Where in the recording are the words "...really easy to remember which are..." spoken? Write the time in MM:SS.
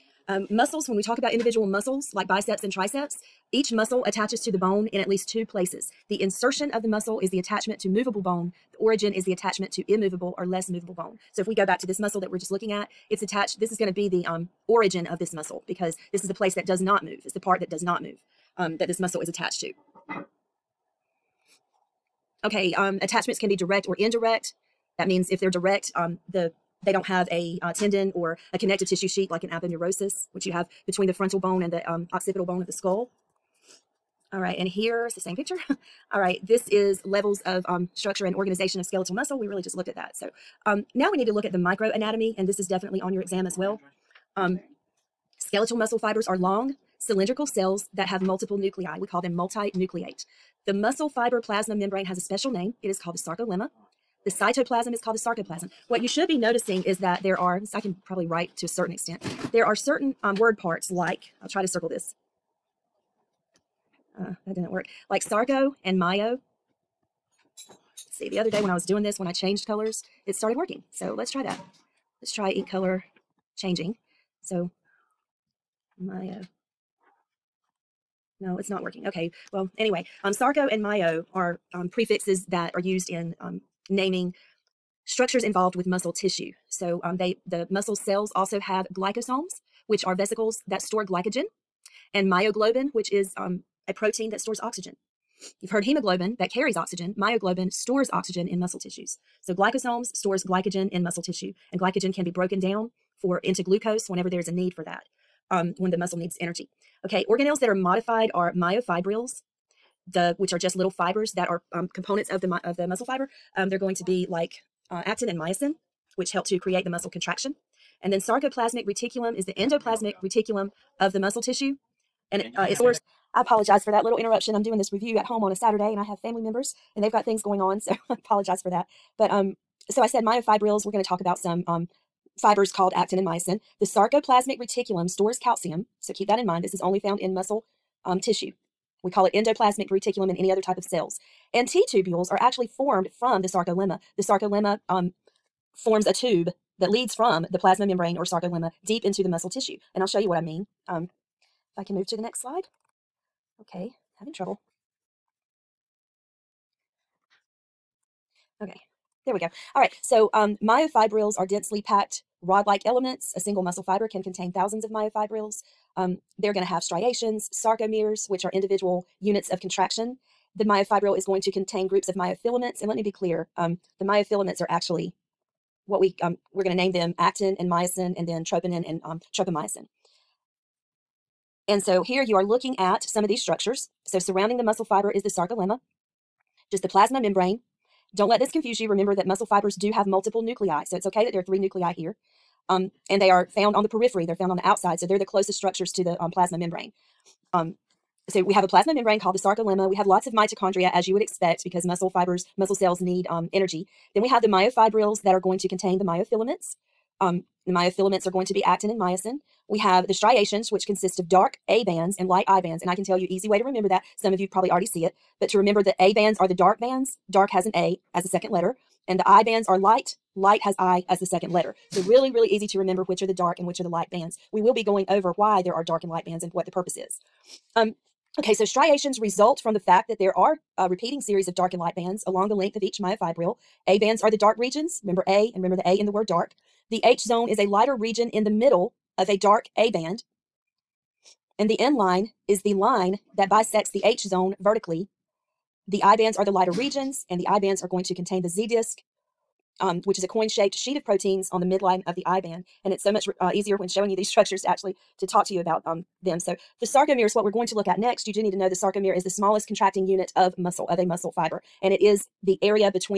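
03:42.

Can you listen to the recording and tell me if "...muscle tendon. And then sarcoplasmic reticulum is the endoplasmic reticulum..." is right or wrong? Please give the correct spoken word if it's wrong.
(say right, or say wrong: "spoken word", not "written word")
wrong: "contraction", not "tendon".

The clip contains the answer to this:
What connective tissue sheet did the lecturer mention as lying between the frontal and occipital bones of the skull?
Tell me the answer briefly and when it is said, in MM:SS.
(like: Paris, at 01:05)
aponeurosis, at 00:29.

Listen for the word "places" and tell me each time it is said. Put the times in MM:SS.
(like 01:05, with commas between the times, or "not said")
00:05, 00:16.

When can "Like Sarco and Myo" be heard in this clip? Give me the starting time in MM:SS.
01:05.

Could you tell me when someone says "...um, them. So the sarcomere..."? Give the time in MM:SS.
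04:15.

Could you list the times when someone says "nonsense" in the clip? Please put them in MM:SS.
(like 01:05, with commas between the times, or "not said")
not said.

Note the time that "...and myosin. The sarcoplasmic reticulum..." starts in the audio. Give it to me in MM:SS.
02:13.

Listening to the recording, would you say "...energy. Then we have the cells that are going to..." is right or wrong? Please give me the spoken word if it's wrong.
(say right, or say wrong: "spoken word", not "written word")
wrong: "myofibrils", not "cells".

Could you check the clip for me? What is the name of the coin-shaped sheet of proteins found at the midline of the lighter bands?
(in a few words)
Z disc.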